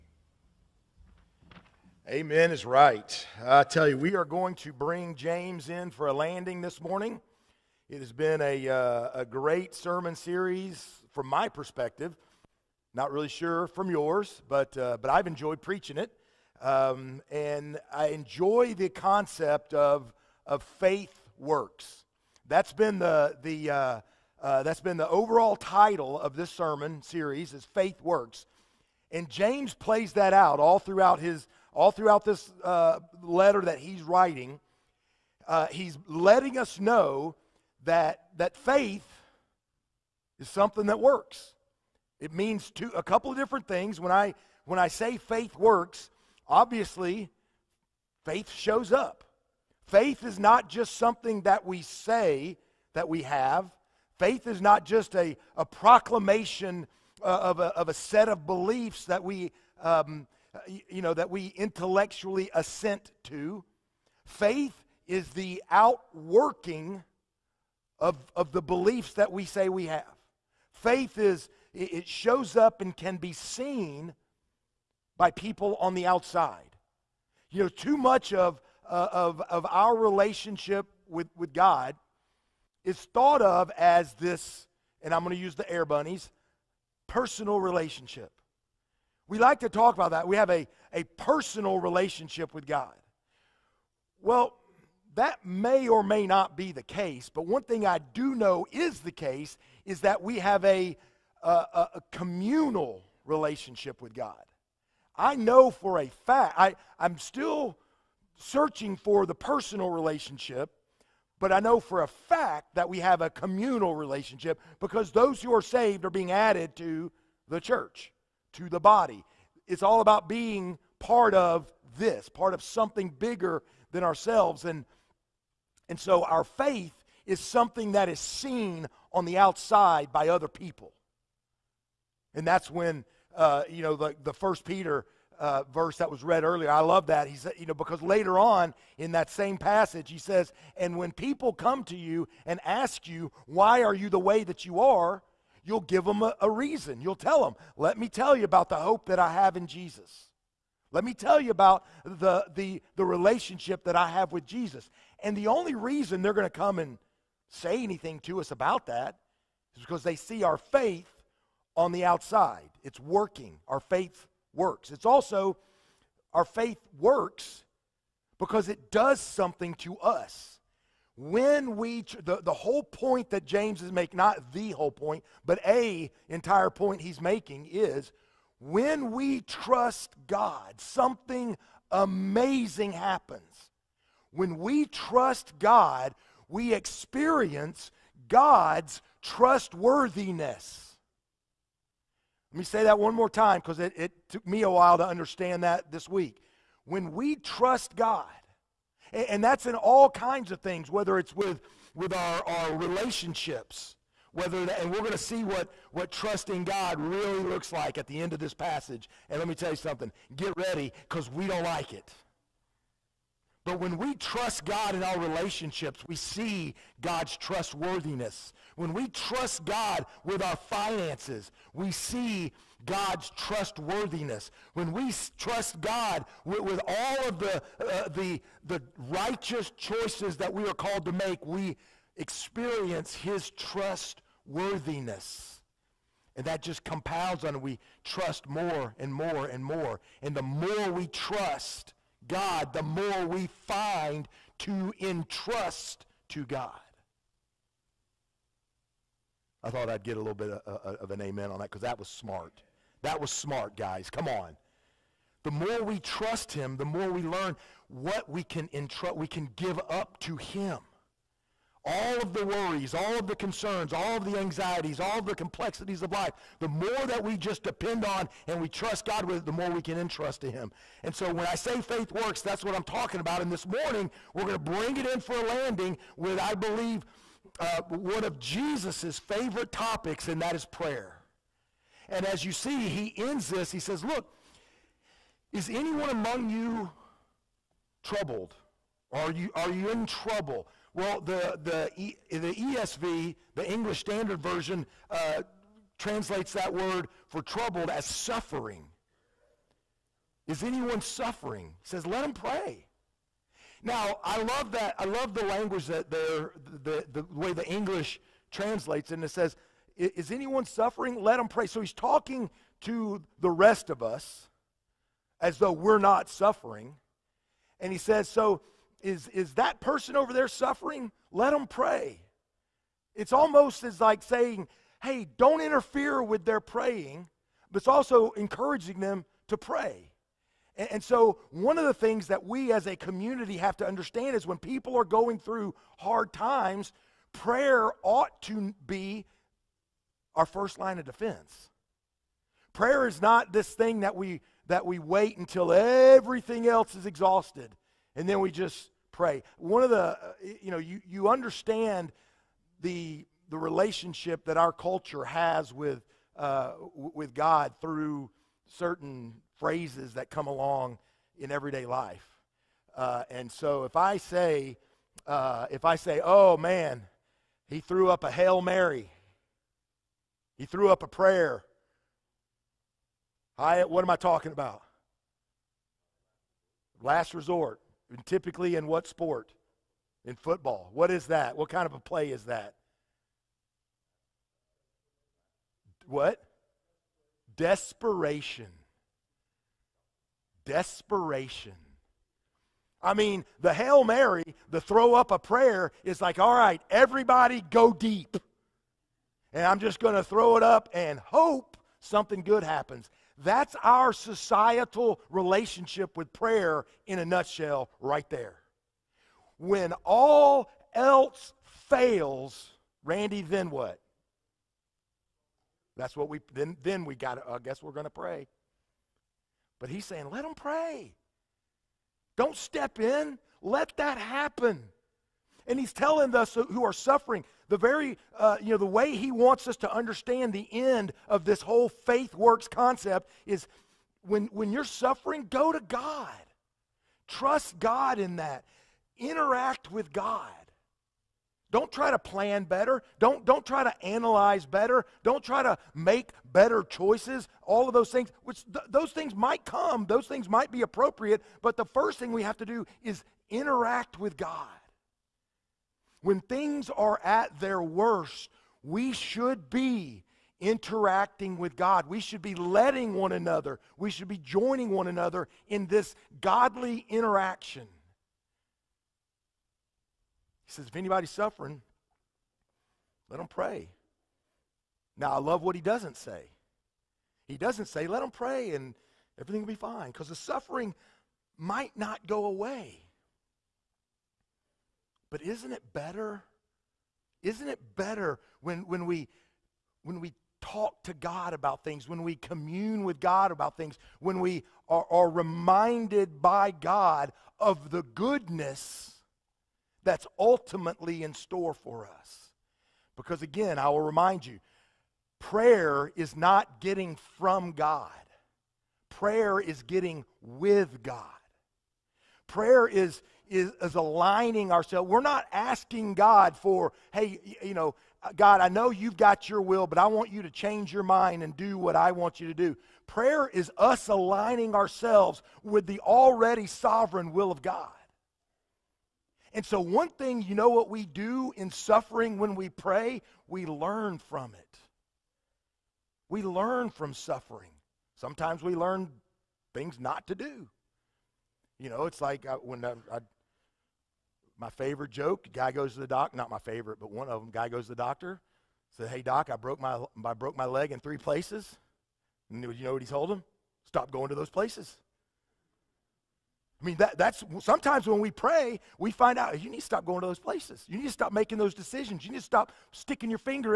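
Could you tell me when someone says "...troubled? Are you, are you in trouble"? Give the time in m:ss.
4:48.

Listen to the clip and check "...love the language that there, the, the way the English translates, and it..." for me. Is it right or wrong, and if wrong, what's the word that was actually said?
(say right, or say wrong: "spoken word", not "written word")
right.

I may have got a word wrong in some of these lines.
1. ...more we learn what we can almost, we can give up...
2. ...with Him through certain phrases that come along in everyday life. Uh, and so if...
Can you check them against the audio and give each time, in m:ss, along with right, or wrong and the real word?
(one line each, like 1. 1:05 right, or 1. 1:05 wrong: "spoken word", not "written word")
1. 4:16 wrong: "entrust", not "almost"
2. 5:56 wrong: "God", not "Him".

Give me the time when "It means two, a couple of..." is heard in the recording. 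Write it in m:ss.
0:42.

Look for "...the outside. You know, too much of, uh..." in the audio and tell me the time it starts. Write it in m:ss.
1:15.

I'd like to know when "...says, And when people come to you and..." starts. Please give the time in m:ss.
2:20.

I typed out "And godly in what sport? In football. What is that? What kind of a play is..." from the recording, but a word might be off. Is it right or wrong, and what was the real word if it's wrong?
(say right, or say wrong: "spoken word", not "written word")
wrong: "typically", not "godly".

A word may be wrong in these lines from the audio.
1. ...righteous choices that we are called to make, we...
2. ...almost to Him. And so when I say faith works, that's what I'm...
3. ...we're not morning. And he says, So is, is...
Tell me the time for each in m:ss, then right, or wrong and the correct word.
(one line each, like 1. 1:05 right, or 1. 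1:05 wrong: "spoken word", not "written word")
1. 3:49 right
2. 4:29 wrong: "entrust", not "almost"
3. 5:15 wrong: "suffering", not "morning".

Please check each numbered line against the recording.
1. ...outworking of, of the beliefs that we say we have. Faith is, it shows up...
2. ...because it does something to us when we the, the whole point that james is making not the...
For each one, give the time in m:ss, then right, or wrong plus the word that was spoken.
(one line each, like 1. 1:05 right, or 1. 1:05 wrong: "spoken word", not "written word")
1. 1:05 right
2. 2:48 right.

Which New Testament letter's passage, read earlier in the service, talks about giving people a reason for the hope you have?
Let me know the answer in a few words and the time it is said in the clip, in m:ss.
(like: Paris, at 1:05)
First Peter, at 2:14.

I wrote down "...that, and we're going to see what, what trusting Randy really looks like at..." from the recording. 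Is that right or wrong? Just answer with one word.
wrong.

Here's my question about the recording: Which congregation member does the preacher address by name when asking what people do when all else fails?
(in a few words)
Randy.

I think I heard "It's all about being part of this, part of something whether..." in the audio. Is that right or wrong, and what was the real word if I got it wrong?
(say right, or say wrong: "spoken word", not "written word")
wrong: "bigger", not "whether".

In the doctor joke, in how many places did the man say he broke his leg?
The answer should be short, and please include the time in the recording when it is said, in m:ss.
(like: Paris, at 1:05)
3, at 9:10.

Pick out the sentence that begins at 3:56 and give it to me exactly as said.
And that just compounds on we trust more and more and more.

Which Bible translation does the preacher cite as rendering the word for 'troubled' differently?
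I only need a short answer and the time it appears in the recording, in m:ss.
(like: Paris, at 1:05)
English Standard Version, at 4:53.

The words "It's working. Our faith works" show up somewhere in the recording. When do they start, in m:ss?
2:42.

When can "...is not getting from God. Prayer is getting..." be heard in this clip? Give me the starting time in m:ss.
8:26.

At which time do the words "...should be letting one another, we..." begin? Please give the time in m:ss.
7:42.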